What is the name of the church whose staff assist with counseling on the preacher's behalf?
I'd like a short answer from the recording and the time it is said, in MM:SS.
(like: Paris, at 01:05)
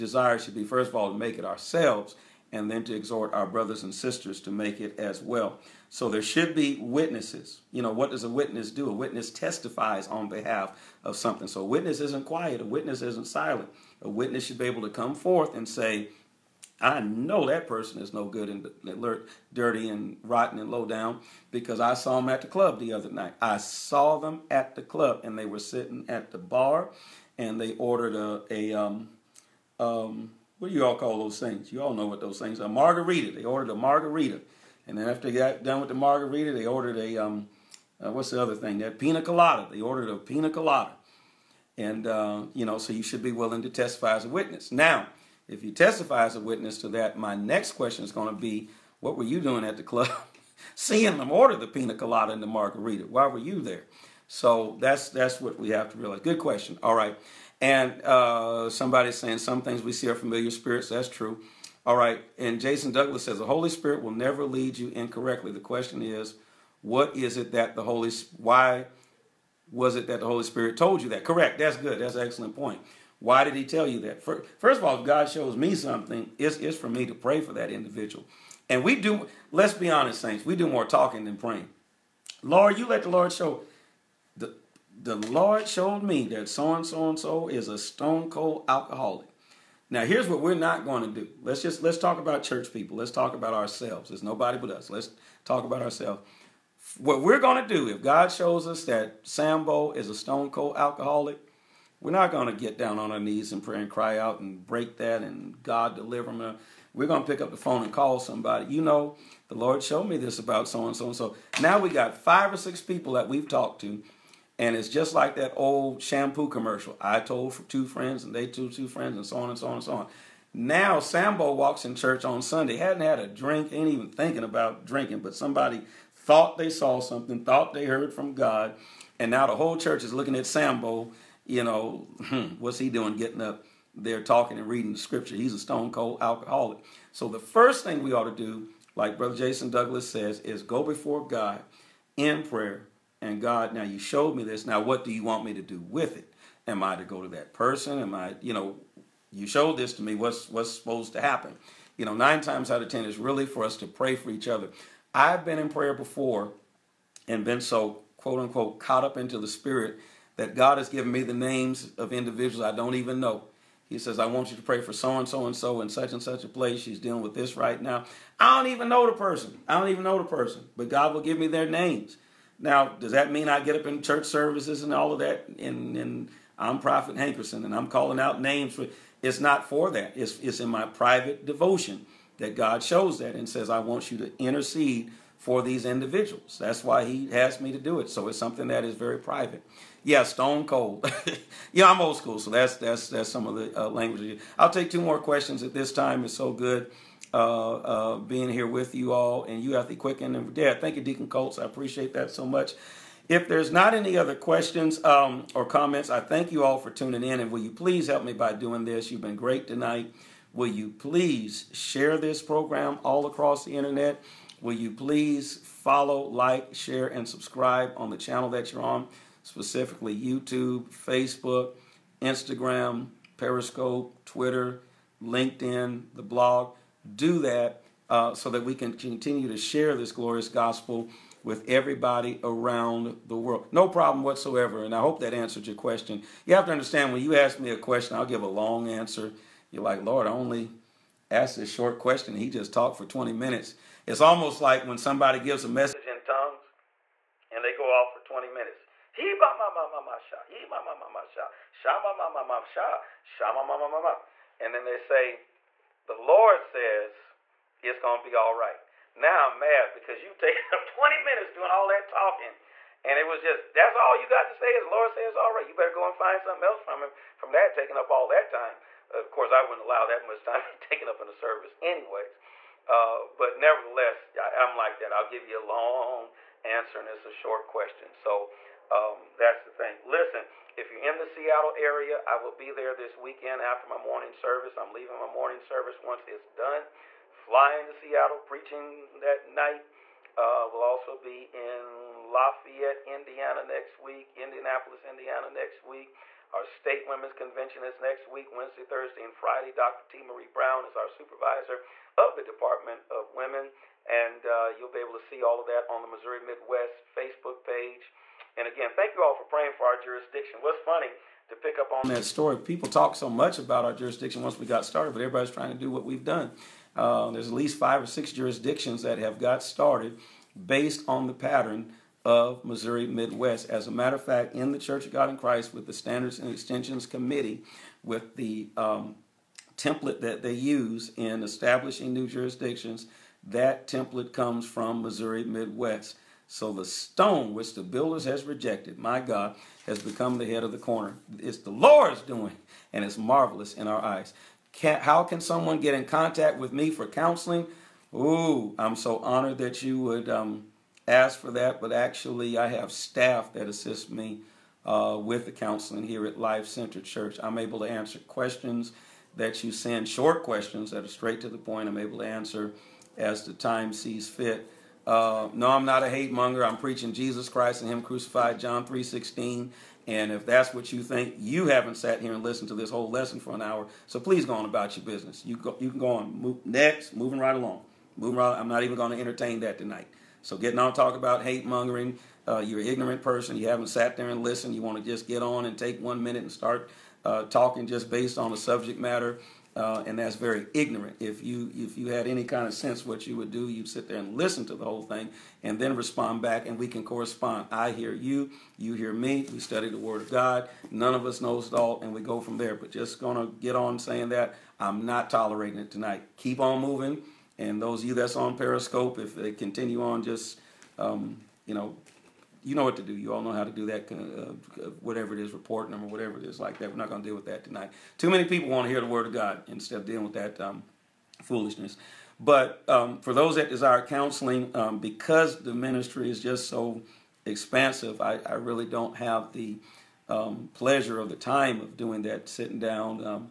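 Life Center Church, at 05:56.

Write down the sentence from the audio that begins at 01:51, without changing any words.
Now we got five or six people that we've talked to and it's just like that old shampoo commercial.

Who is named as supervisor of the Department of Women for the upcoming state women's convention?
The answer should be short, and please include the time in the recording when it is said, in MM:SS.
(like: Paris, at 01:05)
Dr. T. Marie Brown, at 04:59.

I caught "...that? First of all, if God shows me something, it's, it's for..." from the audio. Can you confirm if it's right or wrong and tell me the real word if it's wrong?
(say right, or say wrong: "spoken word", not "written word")
right.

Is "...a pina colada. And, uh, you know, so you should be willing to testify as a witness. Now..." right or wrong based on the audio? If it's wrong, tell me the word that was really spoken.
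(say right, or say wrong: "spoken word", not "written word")
right.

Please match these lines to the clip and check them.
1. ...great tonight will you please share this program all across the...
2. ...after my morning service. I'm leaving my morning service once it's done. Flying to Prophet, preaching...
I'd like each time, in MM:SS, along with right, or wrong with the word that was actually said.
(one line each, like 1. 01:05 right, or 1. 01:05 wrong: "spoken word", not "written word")
1. 03:29 right
2. 04:43 wrong: "Seattle", not "Prophet".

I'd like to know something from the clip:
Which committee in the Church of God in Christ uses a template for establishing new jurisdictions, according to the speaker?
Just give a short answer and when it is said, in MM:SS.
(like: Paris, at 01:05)
Standards and Extensions Committee, at 05:25.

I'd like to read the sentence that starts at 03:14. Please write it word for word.
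I'll take two more questions at this time.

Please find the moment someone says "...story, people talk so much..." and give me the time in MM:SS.
05:12.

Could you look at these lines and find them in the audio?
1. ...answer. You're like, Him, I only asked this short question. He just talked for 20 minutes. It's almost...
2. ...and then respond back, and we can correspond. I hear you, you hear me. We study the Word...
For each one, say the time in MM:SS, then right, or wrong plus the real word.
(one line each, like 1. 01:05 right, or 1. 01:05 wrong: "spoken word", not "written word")
1. 03:58 wrong: "Lord", not "Him"
2. 06:35 right.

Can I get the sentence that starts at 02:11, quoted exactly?
You know, hmm, what's he doing?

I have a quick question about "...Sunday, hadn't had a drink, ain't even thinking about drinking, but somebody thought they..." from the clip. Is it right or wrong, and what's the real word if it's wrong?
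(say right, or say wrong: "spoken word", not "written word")
right.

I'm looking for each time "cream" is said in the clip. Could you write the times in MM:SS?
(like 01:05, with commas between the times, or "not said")
not said.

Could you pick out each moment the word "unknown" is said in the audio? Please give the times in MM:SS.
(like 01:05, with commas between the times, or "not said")
not said.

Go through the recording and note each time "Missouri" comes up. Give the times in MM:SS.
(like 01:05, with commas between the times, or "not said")
05:06, 05:22, 05:34.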